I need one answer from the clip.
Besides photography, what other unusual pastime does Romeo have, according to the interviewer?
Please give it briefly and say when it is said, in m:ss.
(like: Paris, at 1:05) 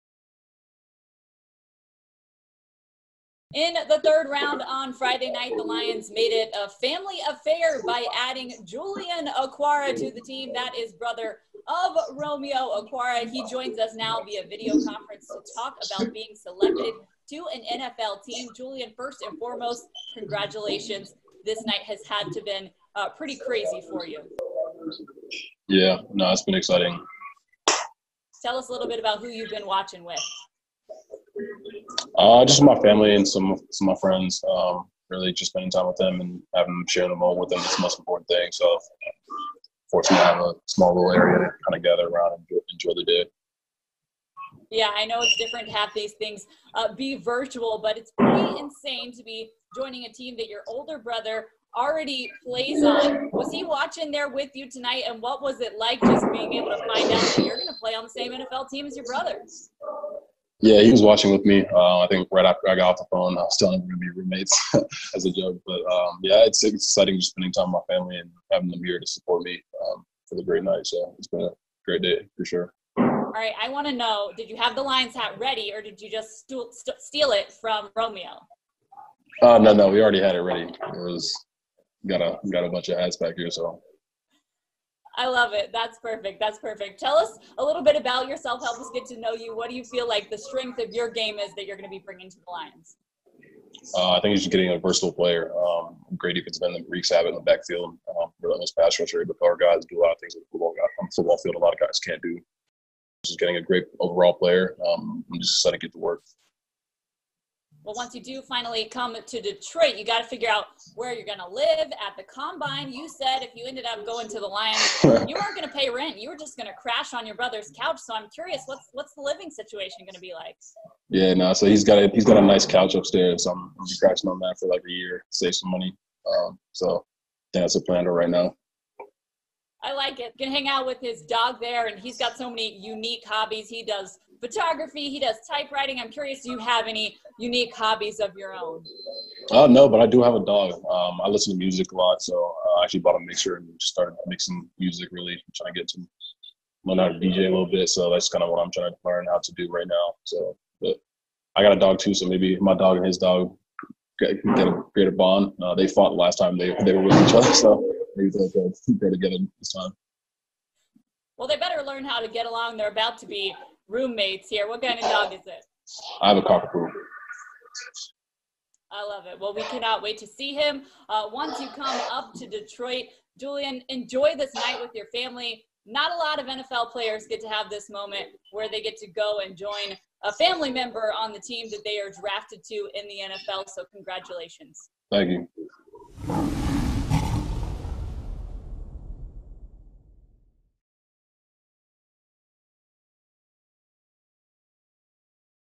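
Typewriting, at 2:15.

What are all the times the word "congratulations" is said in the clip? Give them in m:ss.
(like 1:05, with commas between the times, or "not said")
0:20, 3:03.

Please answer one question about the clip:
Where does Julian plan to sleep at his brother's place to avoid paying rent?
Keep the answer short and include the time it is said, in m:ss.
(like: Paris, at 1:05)
Couch upstairs, at 2:02.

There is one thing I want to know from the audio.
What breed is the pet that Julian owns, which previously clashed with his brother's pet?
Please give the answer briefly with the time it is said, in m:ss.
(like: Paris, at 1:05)
Cockapoo, at 2:46.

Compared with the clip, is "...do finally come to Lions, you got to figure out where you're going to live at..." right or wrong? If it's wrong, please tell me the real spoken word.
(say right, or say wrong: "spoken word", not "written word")
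wrong: "Detroit", not "Lions".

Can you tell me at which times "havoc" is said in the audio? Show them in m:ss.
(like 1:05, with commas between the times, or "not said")
1:37.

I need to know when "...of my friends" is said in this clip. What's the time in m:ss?
0:33.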